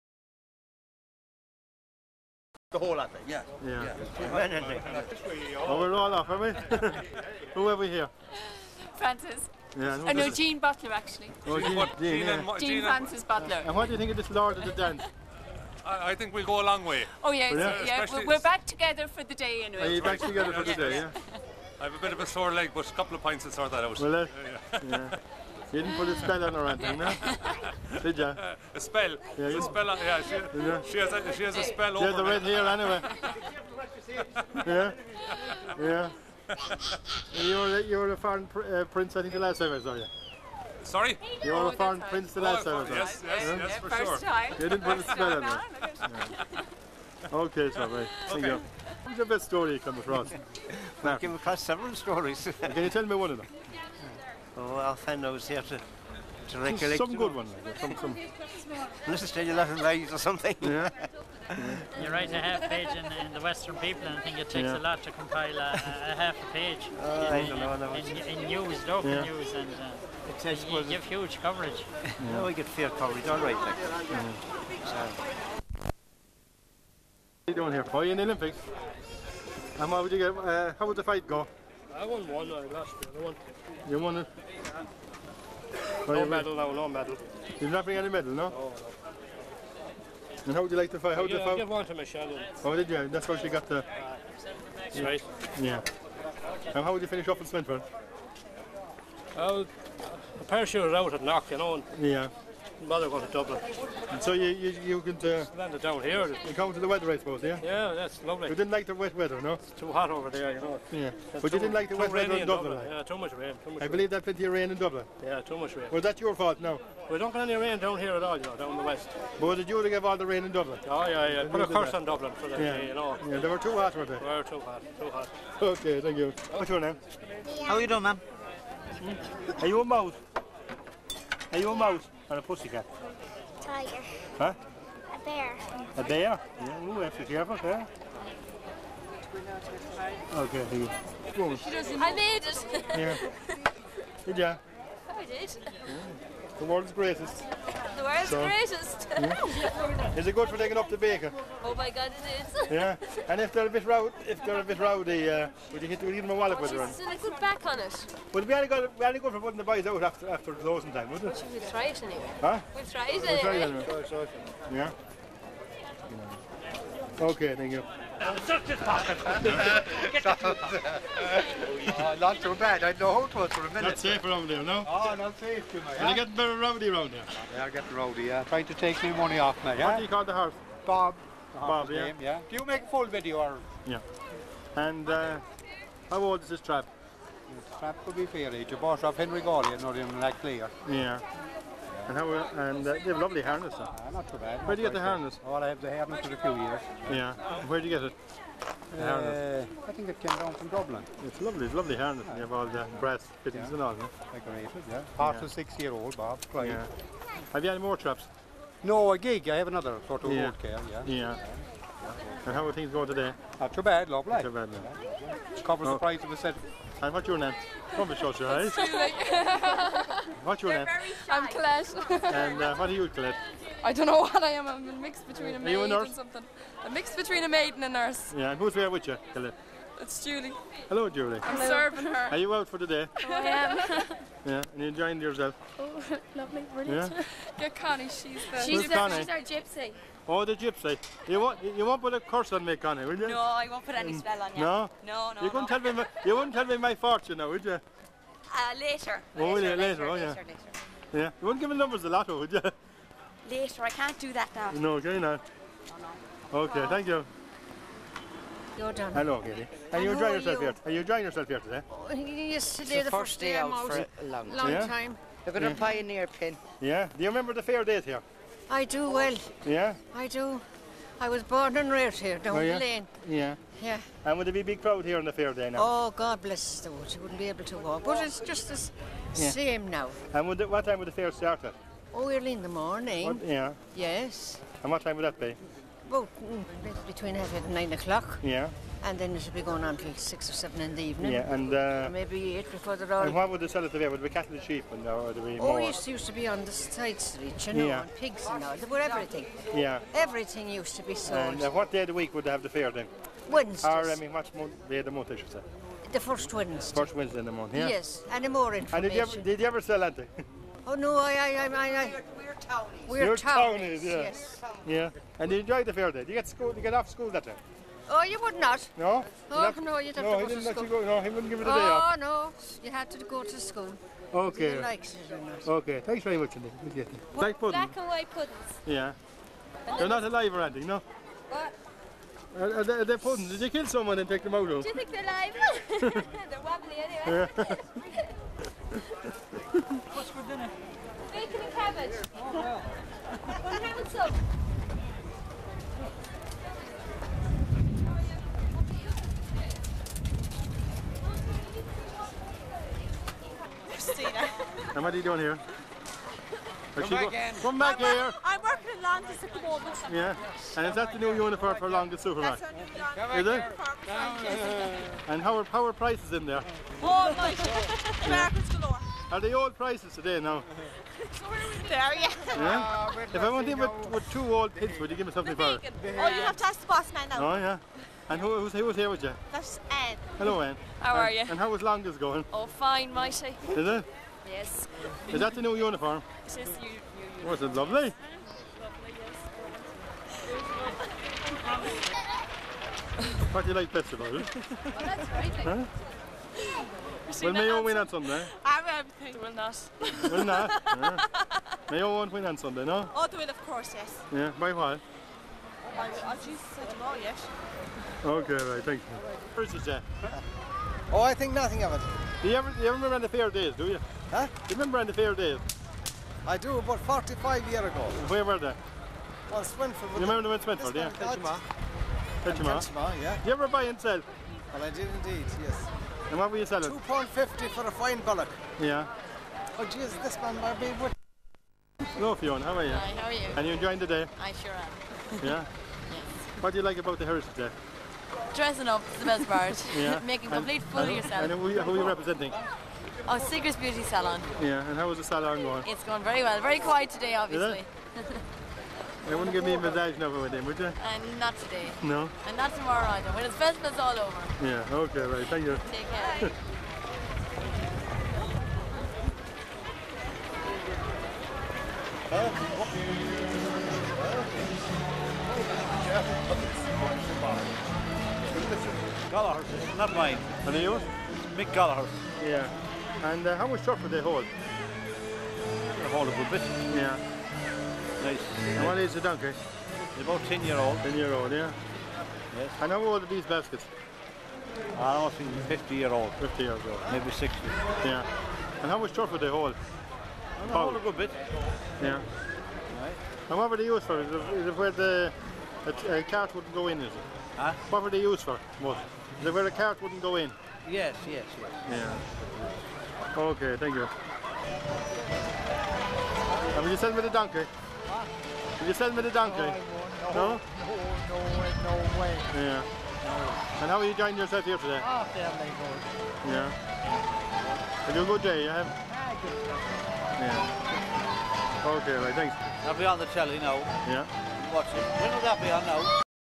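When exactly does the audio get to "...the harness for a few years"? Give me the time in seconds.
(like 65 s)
195 s.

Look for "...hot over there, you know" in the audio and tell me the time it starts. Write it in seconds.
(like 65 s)
109 s.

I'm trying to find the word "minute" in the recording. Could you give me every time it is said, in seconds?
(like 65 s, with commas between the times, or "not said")
173 s.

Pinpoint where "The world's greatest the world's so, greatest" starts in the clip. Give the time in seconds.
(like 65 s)
146 s.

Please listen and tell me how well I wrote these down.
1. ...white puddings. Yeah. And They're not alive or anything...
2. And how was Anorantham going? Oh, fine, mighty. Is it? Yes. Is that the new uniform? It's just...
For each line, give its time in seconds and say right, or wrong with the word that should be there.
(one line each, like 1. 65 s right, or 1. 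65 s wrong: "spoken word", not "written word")
1. 328 s right
2. 381 s wrong: "Londis", not "Anorantham".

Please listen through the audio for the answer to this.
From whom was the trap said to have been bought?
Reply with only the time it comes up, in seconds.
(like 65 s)
189 s.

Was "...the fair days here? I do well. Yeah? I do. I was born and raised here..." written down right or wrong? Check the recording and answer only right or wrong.
right.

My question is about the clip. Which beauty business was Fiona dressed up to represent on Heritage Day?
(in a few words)
Sigrid's Beauty Salon.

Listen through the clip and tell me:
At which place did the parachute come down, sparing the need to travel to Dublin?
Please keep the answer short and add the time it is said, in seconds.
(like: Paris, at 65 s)
Knock, at 101 s.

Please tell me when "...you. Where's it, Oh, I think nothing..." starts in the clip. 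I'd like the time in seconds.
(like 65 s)
409 s.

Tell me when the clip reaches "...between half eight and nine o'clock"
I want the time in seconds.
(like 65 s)
287 s.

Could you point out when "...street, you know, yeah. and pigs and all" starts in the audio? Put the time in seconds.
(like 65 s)
297 s.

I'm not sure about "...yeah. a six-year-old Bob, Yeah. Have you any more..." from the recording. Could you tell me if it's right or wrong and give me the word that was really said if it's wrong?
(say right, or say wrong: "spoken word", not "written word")
right.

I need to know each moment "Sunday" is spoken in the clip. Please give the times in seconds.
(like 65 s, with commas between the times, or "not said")
398 s, 402 s.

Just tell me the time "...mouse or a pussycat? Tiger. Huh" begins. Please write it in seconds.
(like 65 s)
131 s.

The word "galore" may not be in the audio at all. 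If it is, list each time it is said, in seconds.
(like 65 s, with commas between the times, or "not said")
368 s.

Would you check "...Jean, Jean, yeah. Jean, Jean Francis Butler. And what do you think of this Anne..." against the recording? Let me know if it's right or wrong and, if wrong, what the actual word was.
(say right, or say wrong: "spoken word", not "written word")
wrong: "Lord", not "Anne".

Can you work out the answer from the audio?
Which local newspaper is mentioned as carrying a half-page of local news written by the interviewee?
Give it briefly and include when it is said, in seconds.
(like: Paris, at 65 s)
Western People, at 63 s.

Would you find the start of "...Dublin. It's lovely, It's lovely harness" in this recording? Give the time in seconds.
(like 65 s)
200 s.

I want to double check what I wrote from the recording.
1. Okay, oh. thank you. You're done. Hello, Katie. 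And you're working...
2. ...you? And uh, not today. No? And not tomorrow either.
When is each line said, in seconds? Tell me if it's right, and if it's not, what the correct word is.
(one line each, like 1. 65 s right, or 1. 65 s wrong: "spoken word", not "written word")
1. 256 s wrong: "enjoying", not "working"
2. 450 s right.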